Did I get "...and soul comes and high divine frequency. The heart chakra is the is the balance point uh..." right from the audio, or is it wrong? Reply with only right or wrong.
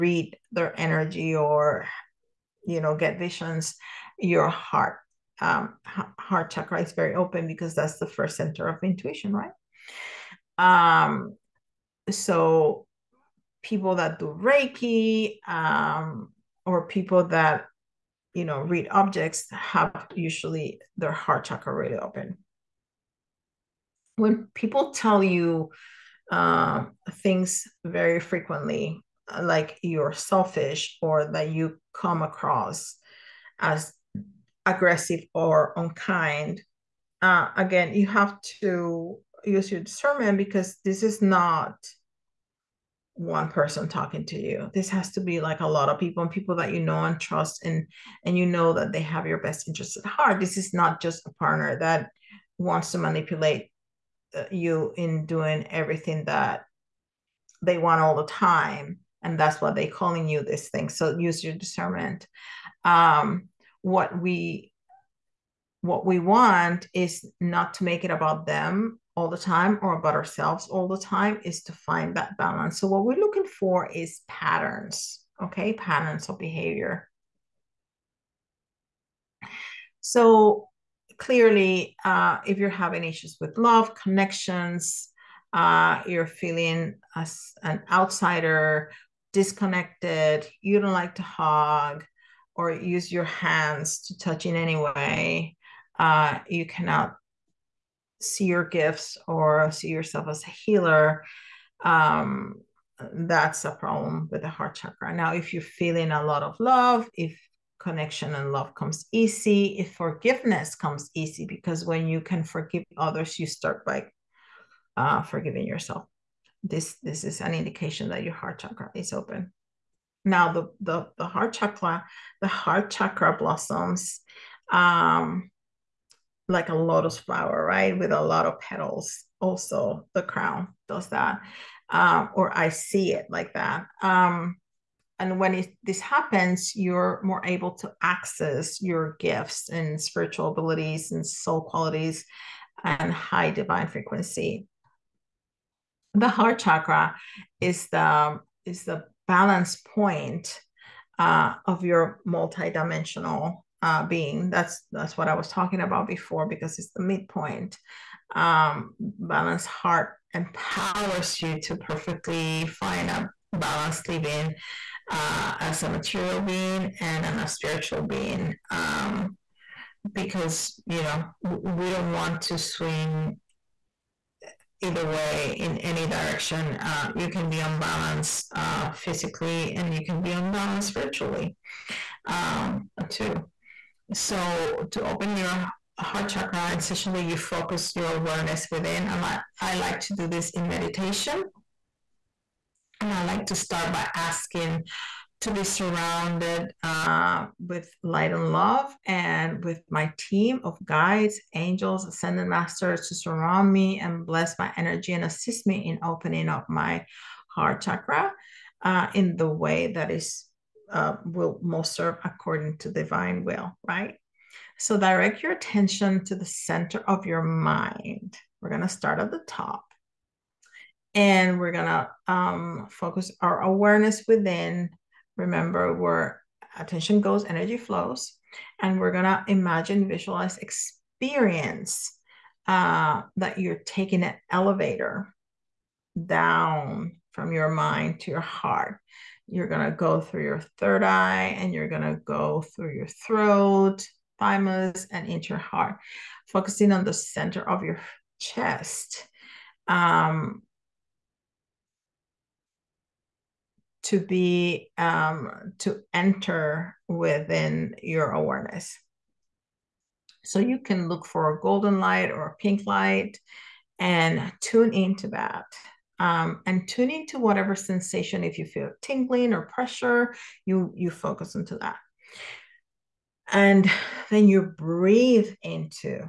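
wrong.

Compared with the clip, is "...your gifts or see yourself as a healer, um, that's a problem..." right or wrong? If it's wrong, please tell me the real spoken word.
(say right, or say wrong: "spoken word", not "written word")
right.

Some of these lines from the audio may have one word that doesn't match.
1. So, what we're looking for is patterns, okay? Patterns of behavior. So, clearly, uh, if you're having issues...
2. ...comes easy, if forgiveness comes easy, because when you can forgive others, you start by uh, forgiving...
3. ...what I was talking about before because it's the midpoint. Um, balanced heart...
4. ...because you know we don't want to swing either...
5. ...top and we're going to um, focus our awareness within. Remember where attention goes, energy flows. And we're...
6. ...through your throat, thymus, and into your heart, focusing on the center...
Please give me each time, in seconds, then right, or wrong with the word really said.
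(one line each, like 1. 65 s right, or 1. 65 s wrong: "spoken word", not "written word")
1. 72 s right
2. 108 s right
3. 155 s right
4. 170 s right
5. 219 s right
6. 242 s right.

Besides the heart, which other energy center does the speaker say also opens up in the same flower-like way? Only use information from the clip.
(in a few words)
The crown.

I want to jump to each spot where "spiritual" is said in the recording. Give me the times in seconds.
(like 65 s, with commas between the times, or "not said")
140 s, 167 s.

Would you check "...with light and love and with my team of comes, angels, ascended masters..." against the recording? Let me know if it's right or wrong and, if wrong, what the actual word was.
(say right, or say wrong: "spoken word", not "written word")
wrong: "guides", not "comes".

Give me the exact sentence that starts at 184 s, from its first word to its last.
So to open your heart chakra, essentially you focus your awareness within.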